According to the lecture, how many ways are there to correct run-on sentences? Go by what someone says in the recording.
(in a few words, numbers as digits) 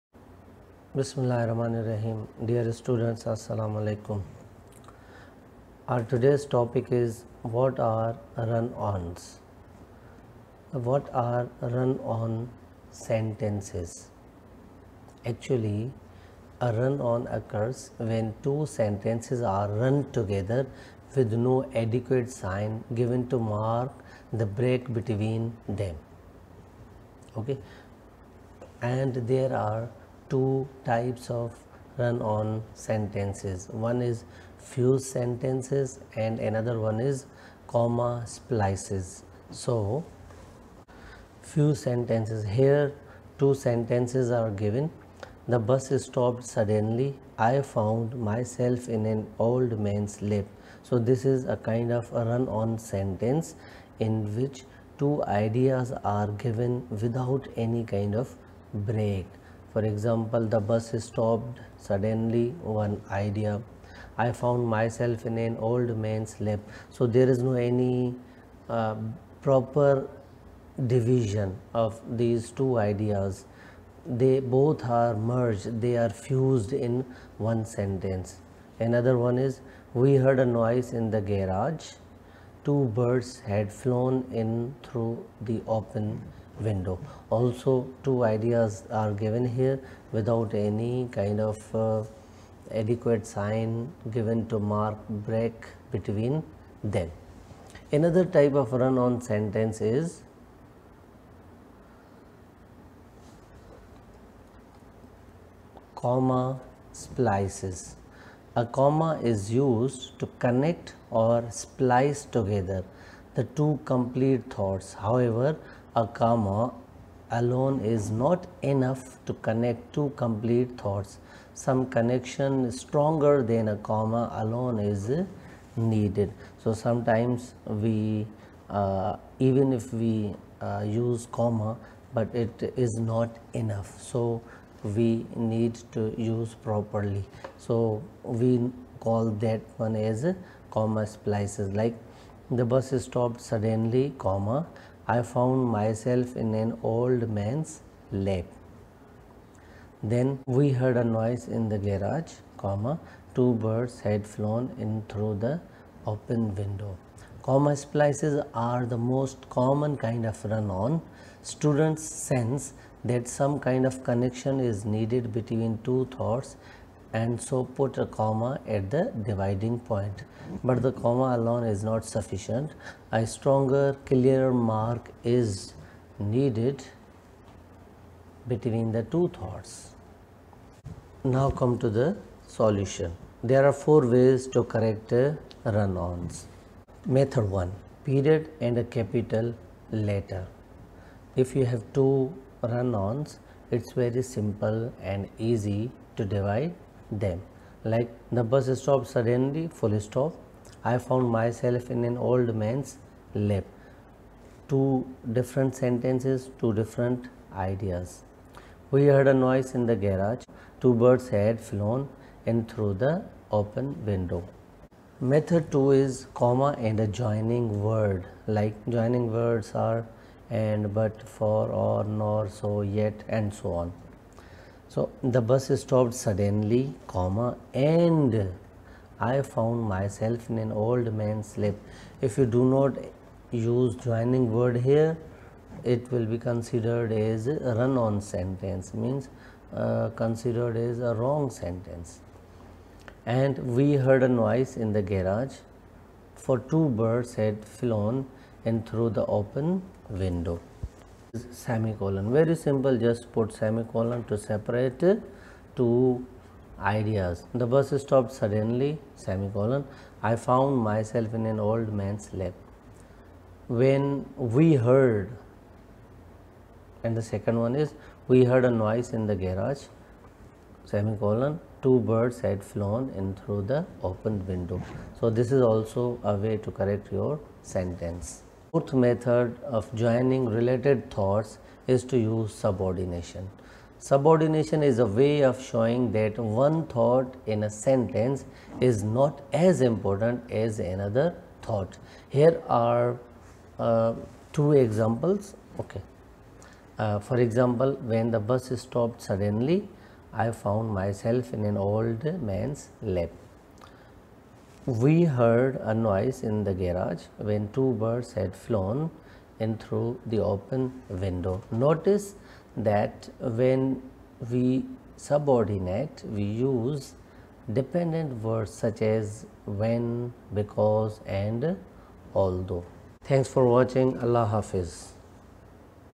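4.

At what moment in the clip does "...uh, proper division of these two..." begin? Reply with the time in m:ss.
1:08.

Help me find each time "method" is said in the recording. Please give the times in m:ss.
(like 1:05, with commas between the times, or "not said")
3:07, 3:35, 4:38.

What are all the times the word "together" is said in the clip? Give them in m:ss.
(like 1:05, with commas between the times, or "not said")
0:20, 1:52.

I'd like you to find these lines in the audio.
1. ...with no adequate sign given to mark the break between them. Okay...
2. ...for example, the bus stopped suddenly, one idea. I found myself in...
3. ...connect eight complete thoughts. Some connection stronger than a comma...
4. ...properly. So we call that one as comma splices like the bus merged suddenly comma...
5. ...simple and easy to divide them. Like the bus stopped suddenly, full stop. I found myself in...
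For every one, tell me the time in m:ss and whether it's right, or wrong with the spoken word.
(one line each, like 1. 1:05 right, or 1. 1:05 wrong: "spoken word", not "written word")
1. 0:21 right
2. 0:59 right
3. 1:59 wrong: "two", not "eight"
4. 2:16 wrong: "stopped", not "merged"
5. 3:14 right.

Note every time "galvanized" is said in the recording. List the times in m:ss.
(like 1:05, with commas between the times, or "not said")
not said.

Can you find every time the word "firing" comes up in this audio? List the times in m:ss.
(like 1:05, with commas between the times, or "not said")
not said.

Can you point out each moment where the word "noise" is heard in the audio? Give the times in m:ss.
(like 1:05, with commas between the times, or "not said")
1:20, 2:31, 3:29, 4:04, 4:28, 5:05.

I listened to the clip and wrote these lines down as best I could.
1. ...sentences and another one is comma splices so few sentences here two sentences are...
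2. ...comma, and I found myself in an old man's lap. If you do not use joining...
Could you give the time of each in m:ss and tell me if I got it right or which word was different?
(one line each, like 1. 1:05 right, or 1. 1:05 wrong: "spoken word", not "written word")
1. 0:35 right
2. 3:47 right.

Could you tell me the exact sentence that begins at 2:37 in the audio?
Comma splices are the most common kind of run-on.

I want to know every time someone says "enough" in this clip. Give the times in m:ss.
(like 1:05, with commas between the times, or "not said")
1:58, 2:13.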